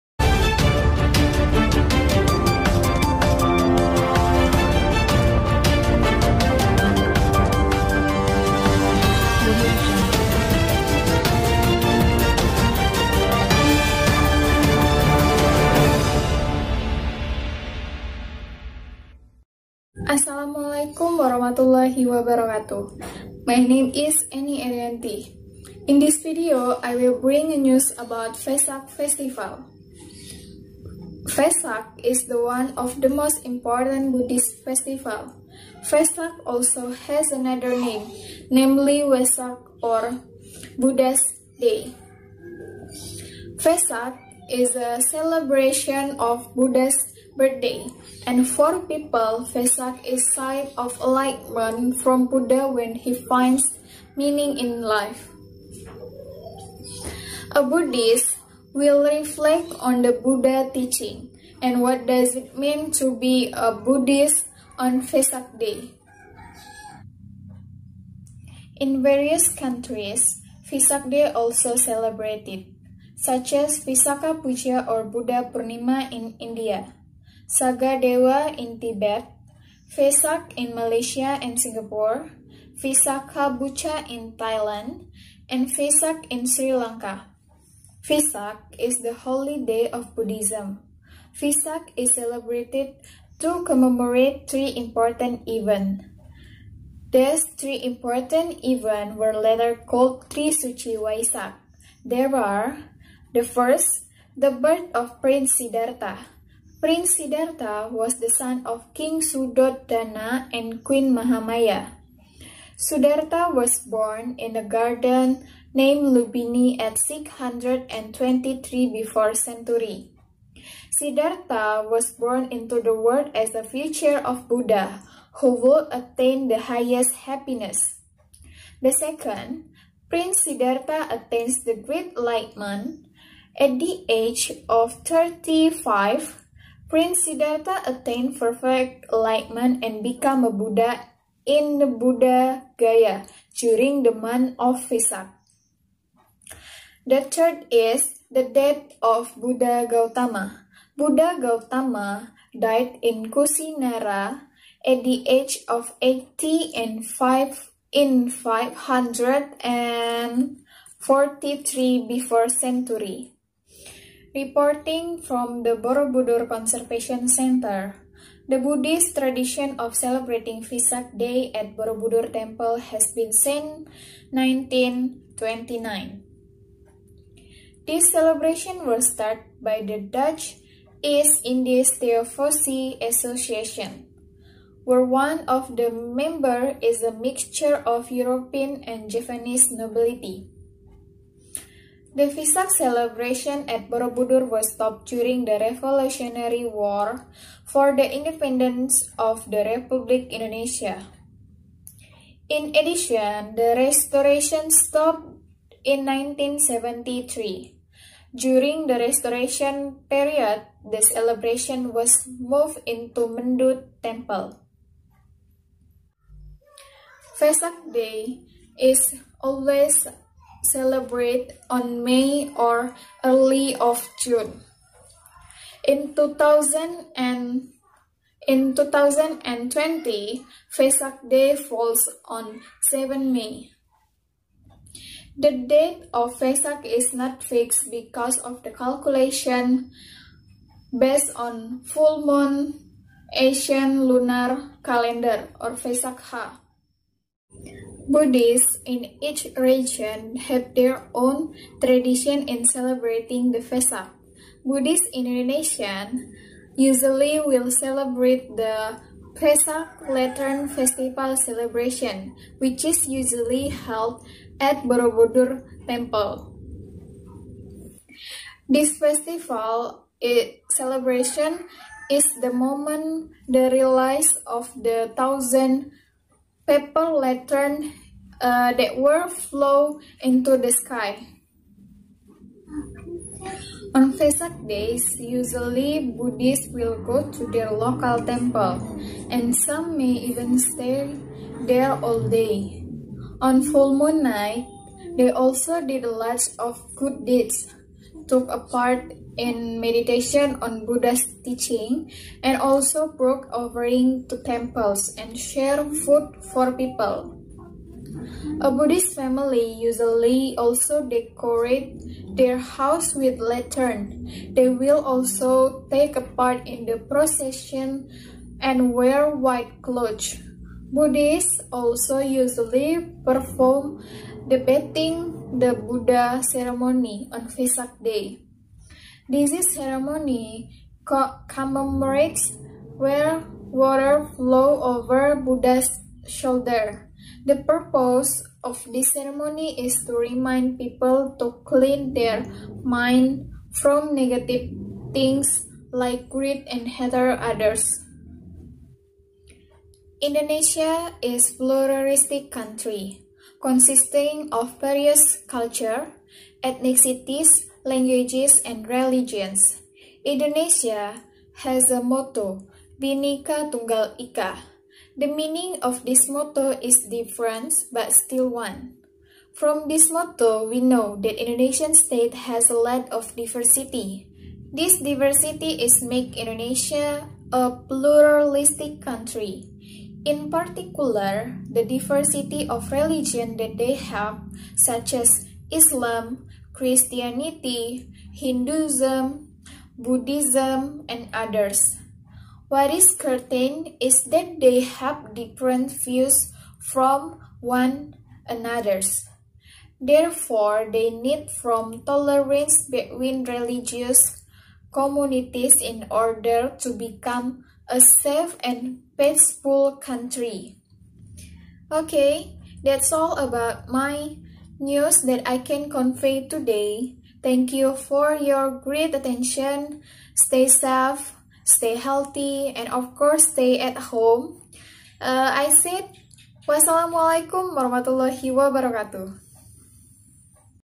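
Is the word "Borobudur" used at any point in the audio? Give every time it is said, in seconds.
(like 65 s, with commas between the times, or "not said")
165 s, 171 s, 193 s, 264 s.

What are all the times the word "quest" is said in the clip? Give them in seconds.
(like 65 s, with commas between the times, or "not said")
not said.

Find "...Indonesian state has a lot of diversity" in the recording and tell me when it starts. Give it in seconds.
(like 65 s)
371 s.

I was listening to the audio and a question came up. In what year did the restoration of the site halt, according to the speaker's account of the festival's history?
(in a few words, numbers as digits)
1973.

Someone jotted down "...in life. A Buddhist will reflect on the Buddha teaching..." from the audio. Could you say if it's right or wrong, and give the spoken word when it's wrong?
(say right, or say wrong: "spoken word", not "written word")
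right.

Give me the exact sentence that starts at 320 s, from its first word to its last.
Buddhists also usually perform the bathing the Buddha ceremony on Vesak Day.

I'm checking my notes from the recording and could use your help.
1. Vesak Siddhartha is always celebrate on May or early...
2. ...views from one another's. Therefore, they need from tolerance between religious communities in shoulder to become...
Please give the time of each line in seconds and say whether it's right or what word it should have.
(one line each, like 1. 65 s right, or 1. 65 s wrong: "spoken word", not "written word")
1. 217 s wrong: "Day", not "Siddhartha"
2. 395 s wrong: "order", not "shoulder".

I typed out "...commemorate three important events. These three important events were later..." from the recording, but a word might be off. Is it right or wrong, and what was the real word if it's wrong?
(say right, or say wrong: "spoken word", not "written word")
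right.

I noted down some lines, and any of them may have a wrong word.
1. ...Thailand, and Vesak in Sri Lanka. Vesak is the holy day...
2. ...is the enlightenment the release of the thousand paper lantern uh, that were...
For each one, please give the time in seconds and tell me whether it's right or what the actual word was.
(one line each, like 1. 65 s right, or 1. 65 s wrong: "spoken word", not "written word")
1. 84 s right
2. 272 s wrong: "moment", not "enlightenment".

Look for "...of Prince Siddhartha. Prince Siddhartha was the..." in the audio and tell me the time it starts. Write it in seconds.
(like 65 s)
104 s.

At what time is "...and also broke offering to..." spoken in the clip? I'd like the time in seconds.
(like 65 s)
302 s.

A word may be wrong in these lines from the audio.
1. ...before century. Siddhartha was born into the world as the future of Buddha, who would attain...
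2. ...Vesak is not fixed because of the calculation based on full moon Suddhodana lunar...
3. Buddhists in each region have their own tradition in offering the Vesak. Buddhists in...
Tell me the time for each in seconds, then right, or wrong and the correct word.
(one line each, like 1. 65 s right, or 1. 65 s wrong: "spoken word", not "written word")
1. 118 s right
2. 236 s wrong: "Asian", not "Suddhodana"
3. 248 s wrong: "celebrating", not "offering".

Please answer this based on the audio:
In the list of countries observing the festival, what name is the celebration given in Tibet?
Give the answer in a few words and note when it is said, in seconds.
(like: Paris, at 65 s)
Saga Dewa, at 77 s.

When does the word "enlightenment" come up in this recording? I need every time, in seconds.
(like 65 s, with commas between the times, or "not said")
51 s, 132 s, 139 s.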